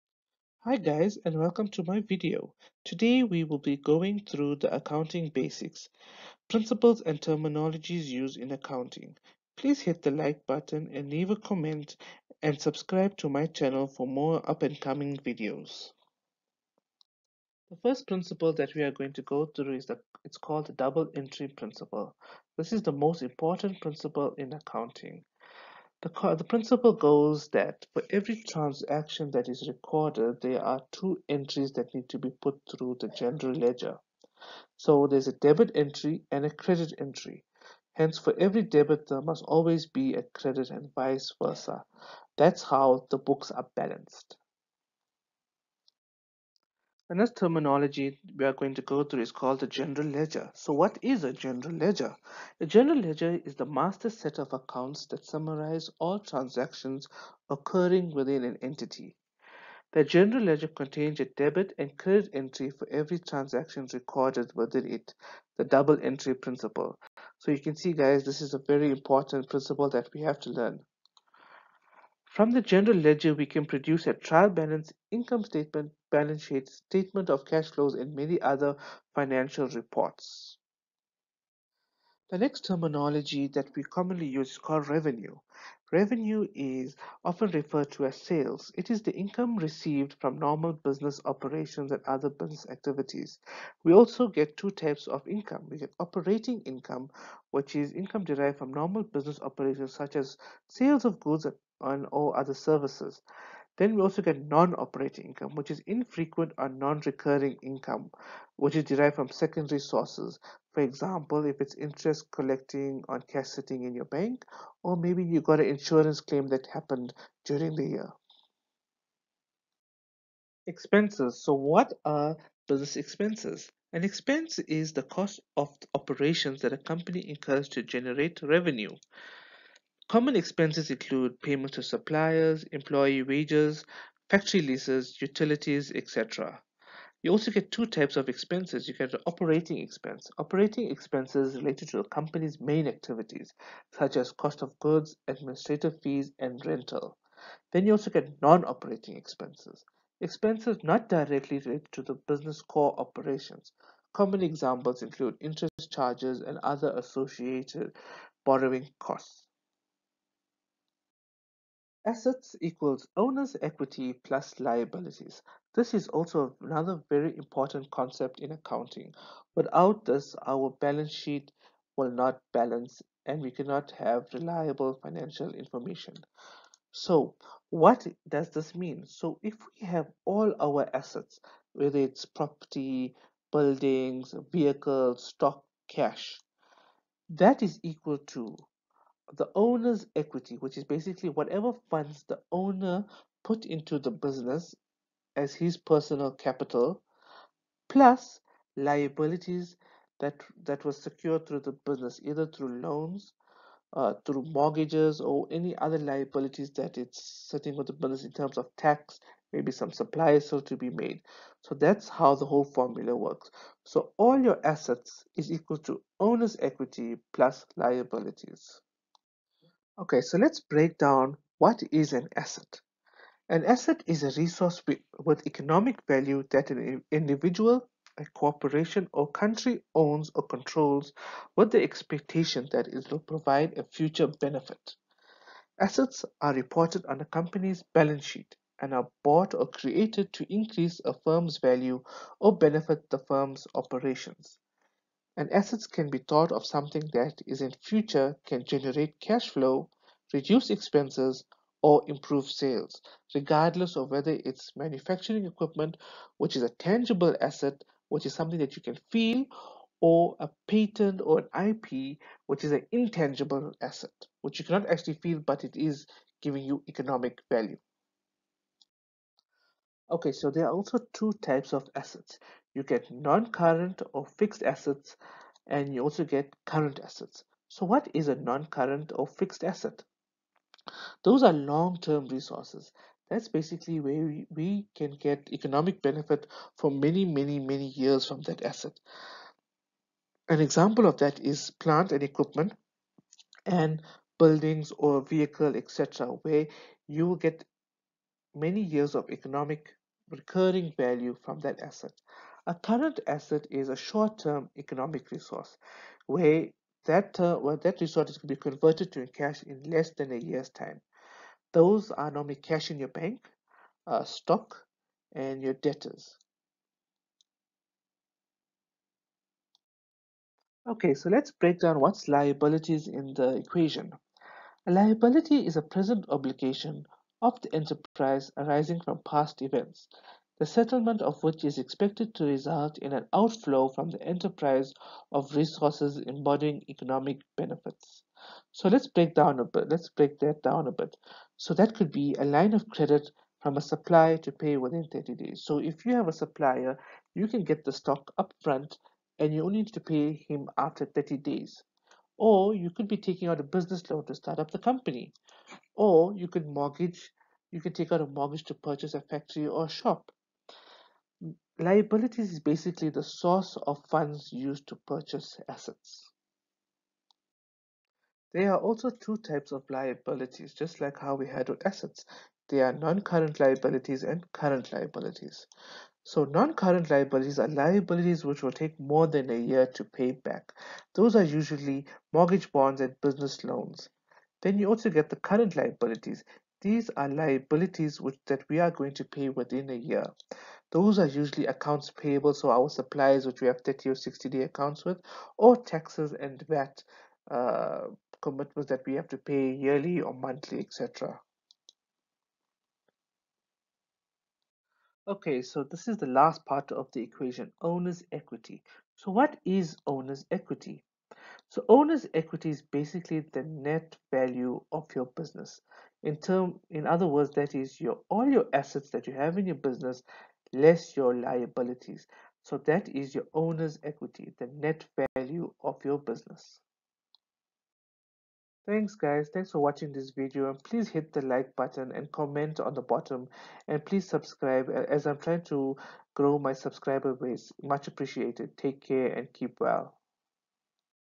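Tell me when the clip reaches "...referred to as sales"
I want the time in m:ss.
1:27.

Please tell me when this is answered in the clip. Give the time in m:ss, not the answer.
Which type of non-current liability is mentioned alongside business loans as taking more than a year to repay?
6:22.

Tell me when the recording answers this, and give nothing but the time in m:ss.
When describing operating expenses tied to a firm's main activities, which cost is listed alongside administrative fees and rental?
2:24.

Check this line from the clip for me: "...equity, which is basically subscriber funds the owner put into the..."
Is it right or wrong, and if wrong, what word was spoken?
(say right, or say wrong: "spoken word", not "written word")
wrong: "whatever", not "subscriber".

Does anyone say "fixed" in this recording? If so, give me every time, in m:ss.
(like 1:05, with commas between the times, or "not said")
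4:34, 4:39.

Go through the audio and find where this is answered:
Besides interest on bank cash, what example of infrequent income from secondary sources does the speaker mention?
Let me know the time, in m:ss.
1:55.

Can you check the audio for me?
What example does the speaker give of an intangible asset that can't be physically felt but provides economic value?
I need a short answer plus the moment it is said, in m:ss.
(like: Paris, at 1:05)
A patent, at 4:20.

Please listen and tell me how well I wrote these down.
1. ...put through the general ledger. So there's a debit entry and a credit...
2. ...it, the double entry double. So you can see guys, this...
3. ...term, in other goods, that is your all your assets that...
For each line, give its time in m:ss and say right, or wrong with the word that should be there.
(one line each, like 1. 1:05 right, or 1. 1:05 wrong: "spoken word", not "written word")
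1. 0:32 right
2. 1:04 wrong: "principle", not "double"
3. 6:56 wrong: "words", not "goods".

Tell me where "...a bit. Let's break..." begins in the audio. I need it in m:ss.
5:39.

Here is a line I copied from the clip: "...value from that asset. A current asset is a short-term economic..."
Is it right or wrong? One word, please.
right.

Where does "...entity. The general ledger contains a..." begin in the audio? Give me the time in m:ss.
0:58.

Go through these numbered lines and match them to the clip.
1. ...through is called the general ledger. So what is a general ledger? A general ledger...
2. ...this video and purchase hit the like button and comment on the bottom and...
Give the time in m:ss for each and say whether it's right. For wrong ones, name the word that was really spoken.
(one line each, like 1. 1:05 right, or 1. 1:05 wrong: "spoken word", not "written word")
1. 0:49 right
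2. 7:10 wrong: "please", not "purchase".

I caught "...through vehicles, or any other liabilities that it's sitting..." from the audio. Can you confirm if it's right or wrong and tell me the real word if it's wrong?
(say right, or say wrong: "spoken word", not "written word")
wrong: "mortgages", not "vehicles".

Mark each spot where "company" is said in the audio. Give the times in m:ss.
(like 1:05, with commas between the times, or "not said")
2:06, 2:22, 3:57, 5:54.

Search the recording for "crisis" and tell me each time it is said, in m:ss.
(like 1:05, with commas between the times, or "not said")
not said.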